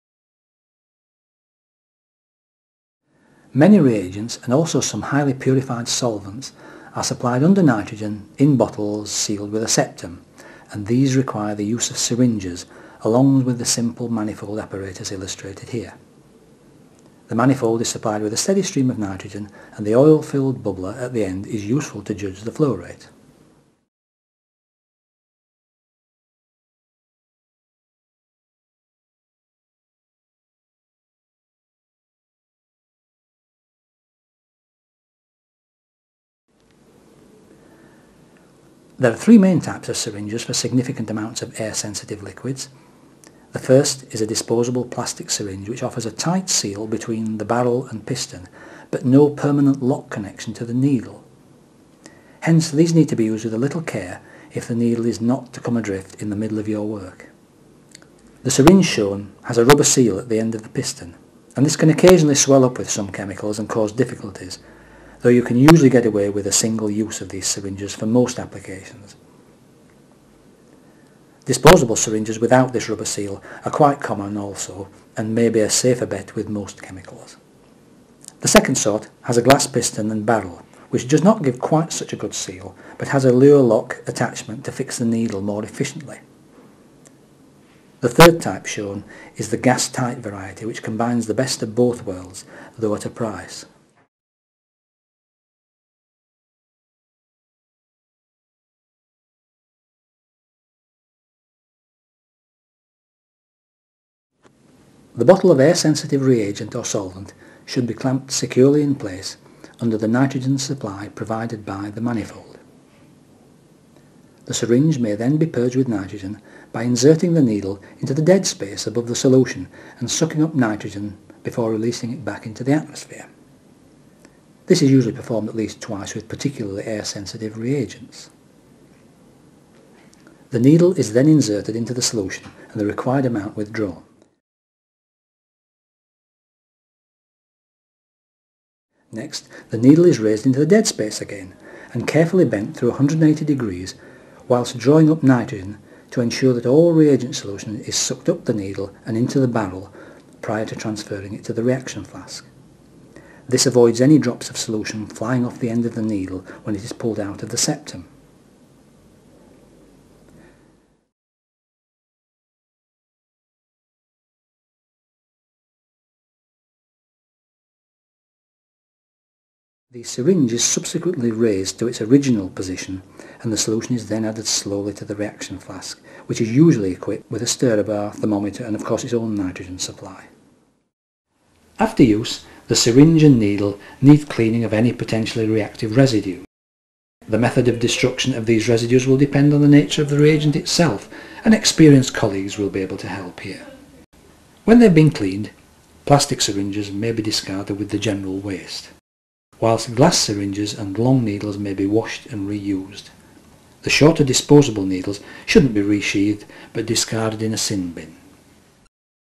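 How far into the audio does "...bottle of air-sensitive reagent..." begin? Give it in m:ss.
1:45.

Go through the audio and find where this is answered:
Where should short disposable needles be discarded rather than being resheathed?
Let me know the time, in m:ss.
3:27.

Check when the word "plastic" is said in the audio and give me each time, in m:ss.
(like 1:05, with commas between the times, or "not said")
0:44, 3:16.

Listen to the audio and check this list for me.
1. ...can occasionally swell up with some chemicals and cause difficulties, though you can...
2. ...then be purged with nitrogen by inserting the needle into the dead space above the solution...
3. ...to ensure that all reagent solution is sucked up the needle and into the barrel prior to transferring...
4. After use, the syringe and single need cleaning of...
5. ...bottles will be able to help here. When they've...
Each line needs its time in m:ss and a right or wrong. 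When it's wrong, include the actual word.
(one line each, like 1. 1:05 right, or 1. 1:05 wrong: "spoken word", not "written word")
1. 1:01 right
2. 1:55 right
3. 2:26 right
4. 3:01 wrong: "needle", not "single"
5. 3:12 wrong: "colleagues", not "bottles".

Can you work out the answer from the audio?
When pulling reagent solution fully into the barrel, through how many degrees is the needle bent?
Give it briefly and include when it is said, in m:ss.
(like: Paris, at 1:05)
180, at 2:22.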